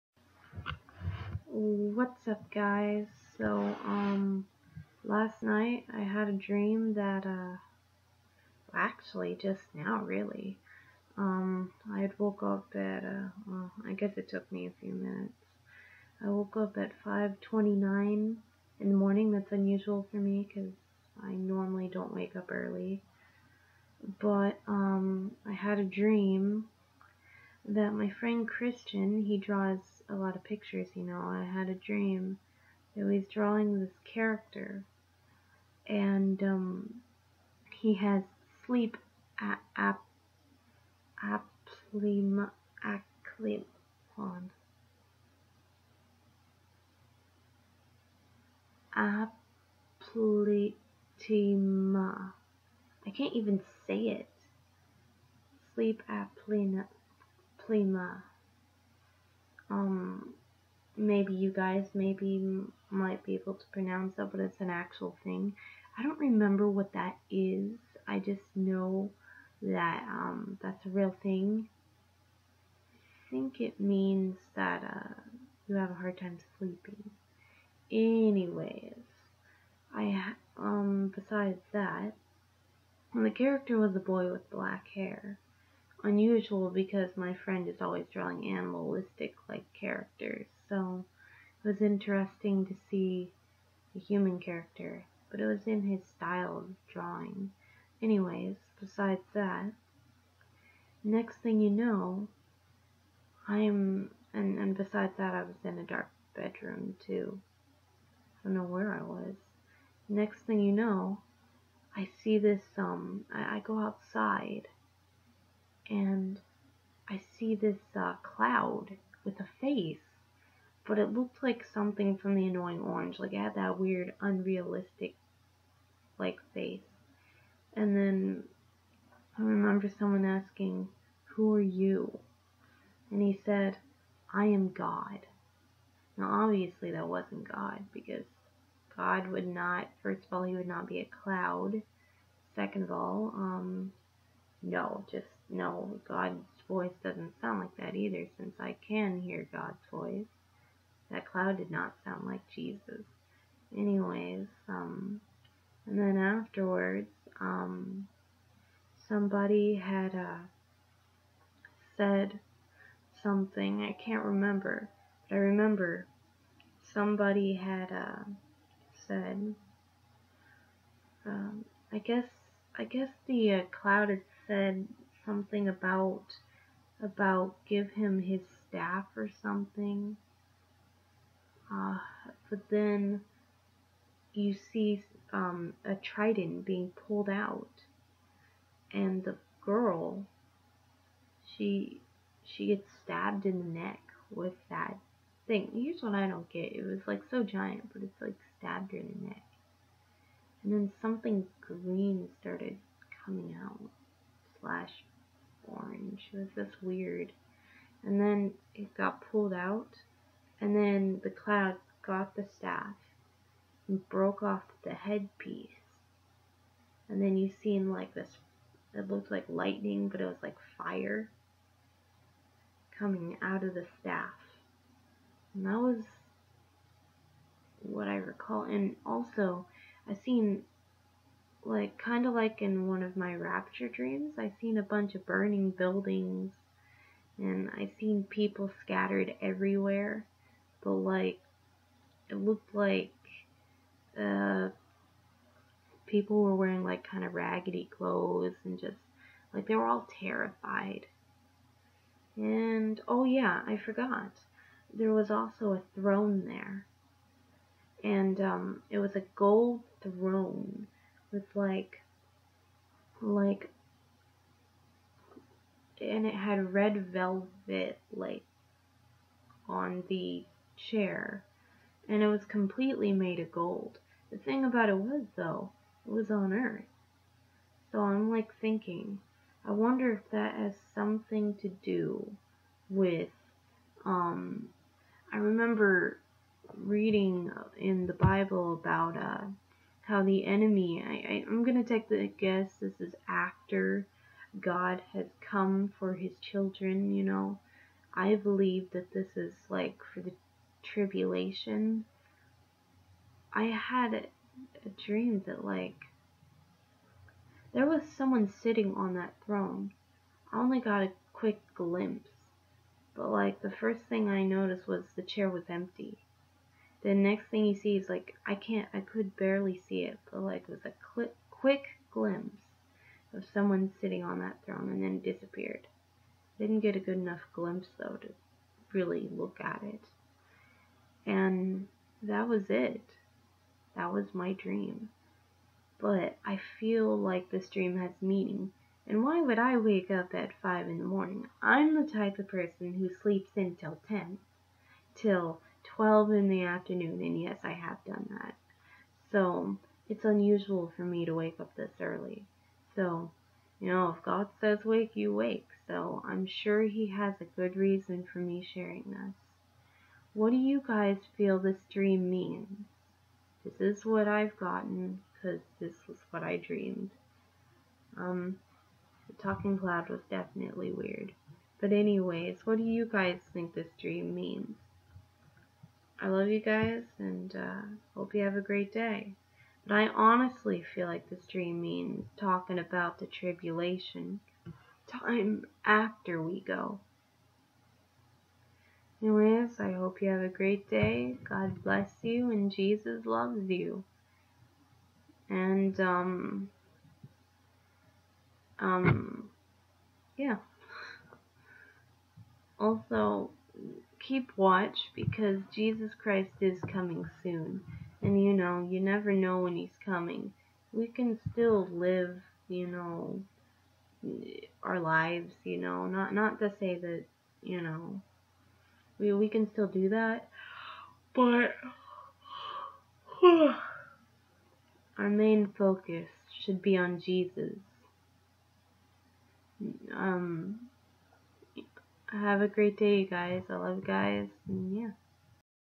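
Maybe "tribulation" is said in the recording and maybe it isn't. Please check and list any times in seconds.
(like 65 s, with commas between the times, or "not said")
300 s, 383 s.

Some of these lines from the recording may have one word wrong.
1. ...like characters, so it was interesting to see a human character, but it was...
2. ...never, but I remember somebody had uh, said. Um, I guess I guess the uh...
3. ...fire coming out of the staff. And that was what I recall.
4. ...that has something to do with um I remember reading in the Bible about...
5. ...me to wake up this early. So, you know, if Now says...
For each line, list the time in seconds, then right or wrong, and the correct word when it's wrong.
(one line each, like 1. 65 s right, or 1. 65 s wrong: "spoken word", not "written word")
1. 89 s right
2. 164 s wrong: "remember", not "never"
3. 220 s right
4. 280 s right
5. 351 s wrong: "God", not "Now".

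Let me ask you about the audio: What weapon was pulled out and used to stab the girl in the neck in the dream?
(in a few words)
trident.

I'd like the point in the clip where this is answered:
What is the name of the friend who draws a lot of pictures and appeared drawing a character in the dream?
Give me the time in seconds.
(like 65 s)
28 s.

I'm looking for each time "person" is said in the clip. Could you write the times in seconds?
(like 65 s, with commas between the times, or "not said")
342 s.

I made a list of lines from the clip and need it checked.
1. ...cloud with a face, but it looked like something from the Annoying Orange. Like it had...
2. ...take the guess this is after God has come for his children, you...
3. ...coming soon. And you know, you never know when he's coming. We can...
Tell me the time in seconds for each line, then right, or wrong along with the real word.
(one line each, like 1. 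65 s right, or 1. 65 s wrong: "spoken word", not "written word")
1. 118 s right
2. 291 s right
3. 406 s right.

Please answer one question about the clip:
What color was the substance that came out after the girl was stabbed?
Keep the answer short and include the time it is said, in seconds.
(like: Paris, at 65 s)
green, at 201 s.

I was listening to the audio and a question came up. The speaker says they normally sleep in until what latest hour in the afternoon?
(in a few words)
12.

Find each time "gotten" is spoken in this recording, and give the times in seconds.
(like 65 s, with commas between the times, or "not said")
364 s.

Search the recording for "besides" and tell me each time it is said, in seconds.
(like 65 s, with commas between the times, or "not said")
81 s, 98 s, 104 s.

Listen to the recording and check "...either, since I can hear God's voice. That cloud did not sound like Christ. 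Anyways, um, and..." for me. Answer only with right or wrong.
wrong.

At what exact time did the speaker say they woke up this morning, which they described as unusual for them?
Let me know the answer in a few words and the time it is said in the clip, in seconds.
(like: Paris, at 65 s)
5:29, at 17 s.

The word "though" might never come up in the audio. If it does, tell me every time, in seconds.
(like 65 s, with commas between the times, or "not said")
275 s, 327 s.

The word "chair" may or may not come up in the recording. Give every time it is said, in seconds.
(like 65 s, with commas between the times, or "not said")
270 s, 315 s.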